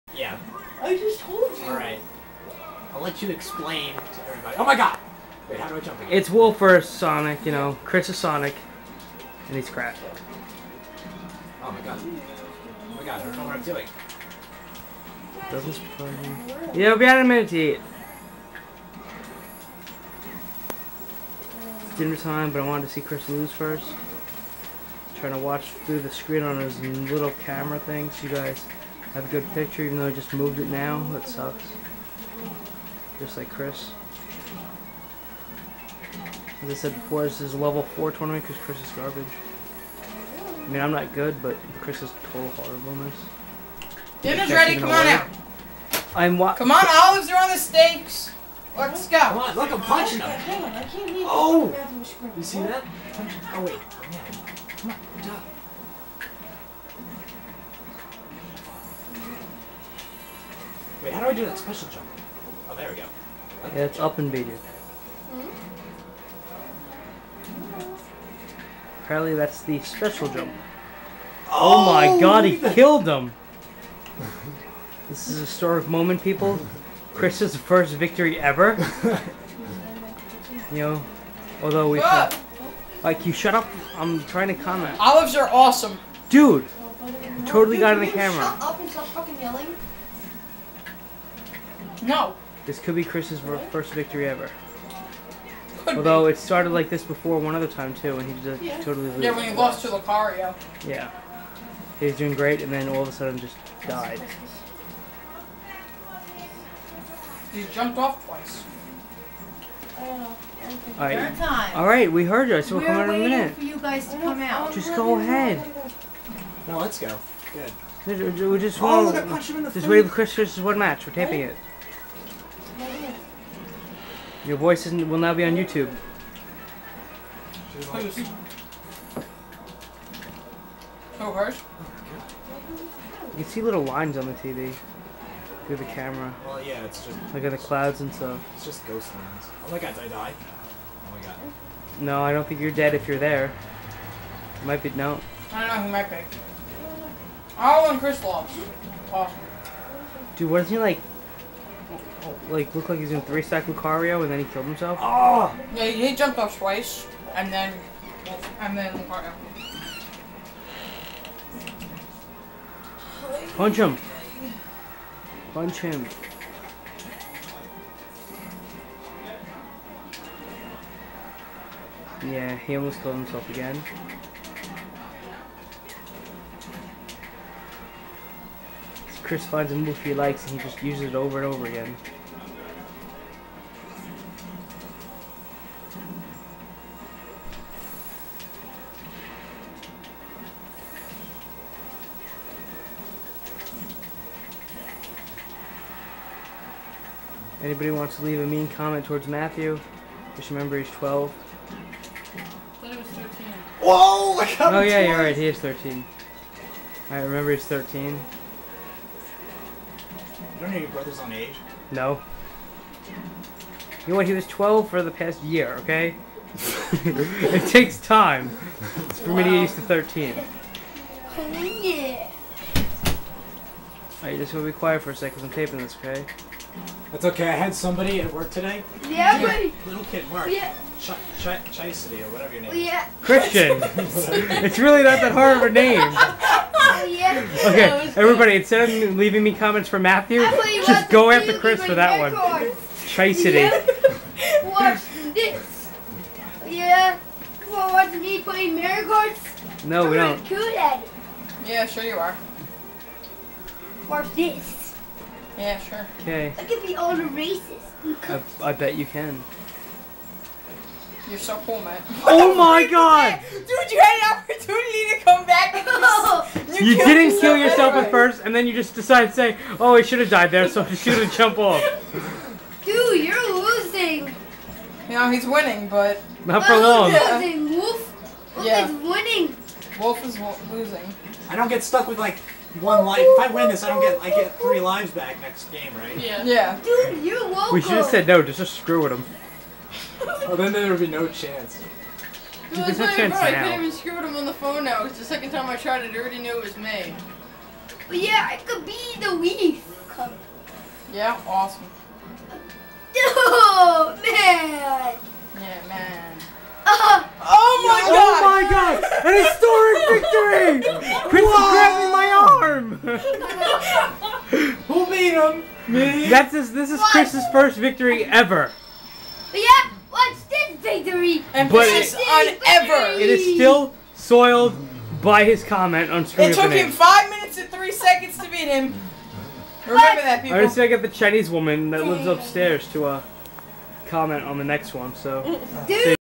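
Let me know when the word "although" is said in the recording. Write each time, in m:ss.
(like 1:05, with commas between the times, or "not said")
1:21, 1:35.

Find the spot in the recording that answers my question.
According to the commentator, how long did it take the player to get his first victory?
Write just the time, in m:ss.
5:26.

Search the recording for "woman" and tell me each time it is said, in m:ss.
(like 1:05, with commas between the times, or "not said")
5:31.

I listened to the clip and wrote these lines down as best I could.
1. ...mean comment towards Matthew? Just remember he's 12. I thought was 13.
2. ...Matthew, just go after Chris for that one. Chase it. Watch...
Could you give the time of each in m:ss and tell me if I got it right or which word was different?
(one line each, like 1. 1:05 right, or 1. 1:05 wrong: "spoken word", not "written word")
1. 3:18 right
2. 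3:59 right.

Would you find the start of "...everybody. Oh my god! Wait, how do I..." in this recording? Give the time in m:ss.
0:04.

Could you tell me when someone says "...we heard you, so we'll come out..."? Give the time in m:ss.
1:52.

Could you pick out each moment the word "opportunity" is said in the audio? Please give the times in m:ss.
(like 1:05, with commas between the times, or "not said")
4:24.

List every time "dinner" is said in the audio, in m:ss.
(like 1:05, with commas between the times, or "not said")
0:21, 0:44.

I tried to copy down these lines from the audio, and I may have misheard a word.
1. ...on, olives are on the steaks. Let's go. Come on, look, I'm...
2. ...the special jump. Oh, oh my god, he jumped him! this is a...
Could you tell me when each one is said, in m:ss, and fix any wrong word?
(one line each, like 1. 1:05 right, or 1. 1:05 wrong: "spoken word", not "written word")
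1. 0:46 right
2. 1:09 wrong: "killed", not "jumped".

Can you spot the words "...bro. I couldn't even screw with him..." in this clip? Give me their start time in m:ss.
4:53.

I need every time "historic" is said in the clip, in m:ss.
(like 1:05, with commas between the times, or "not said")
1:15, 5:10.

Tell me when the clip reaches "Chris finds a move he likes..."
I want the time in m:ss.
2:59.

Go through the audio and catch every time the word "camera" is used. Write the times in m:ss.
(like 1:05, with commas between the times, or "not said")
0:27, 1:28, 2:15.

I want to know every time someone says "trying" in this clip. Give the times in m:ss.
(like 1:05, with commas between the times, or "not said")
0:25, 1:24.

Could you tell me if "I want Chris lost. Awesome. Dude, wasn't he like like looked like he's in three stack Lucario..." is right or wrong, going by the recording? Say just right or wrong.
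right.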